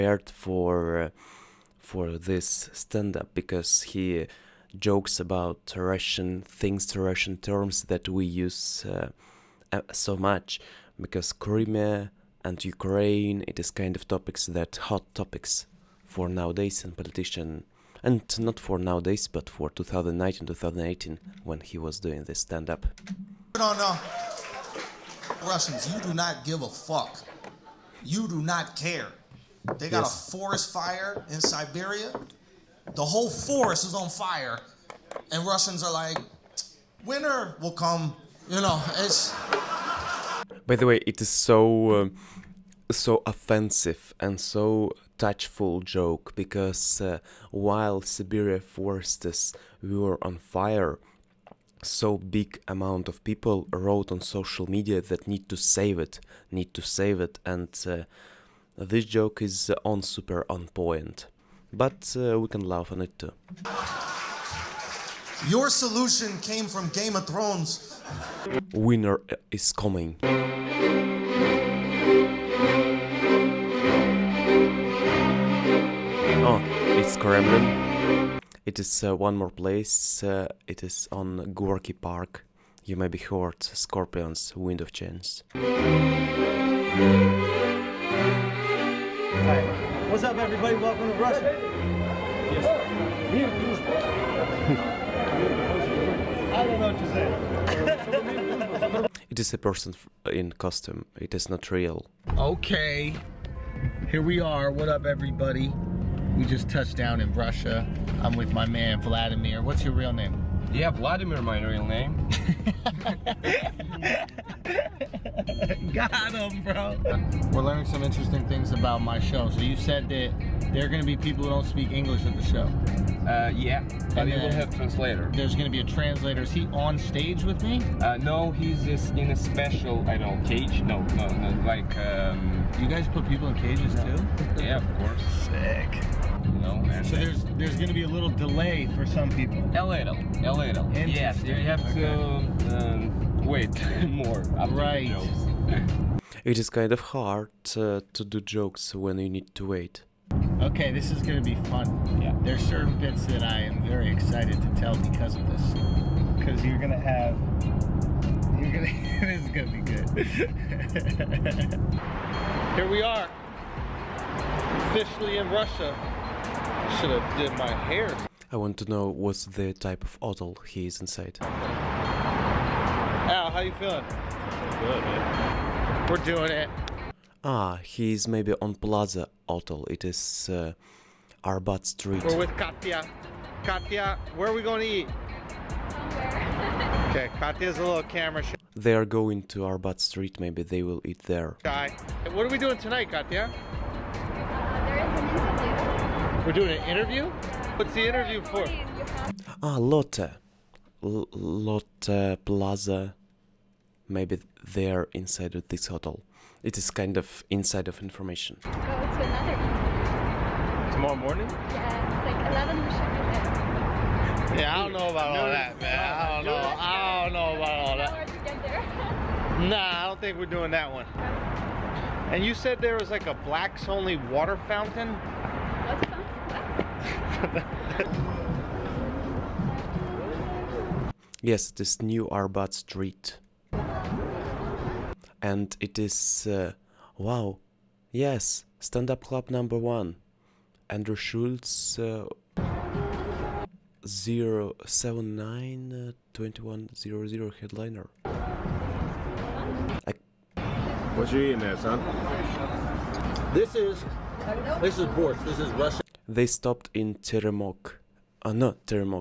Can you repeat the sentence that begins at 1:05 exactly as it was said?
Your solution came from Game of Thrones.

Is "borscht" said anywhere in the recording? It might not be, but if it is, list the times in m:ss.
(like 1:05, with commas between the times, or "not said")
4:15.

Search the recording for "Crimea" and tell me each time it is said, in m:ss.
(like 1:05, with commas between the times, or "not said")
0:11.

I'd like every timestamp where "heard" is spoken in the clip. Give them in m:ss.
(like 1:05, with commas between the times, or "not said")
1:23.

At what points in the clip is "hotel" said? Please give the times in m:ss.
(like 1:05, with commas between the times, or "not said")
2:50, 2:59, 3:25.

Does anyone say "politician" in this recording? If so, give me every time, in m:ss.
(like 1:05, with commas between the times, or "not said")
0:16.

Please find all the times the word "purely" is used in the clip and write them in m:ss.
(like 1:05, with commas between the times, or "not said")
not said.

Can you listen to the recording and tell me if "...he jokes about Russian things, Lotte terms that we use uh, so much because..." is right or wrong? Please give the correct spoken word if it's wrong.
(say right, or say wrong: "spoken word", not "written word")
wrong: "Russian", not "Lotte".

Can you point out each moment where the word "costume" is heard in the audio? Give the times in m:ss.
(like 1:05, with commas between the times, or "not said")
1:40.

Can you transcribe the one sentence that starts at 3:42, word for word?
And you said there was like a blacks only water fountain?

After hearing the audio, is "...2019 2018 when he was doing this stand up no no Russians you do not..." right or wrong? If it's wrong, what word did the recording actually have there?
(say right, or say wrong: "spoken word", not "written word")
right.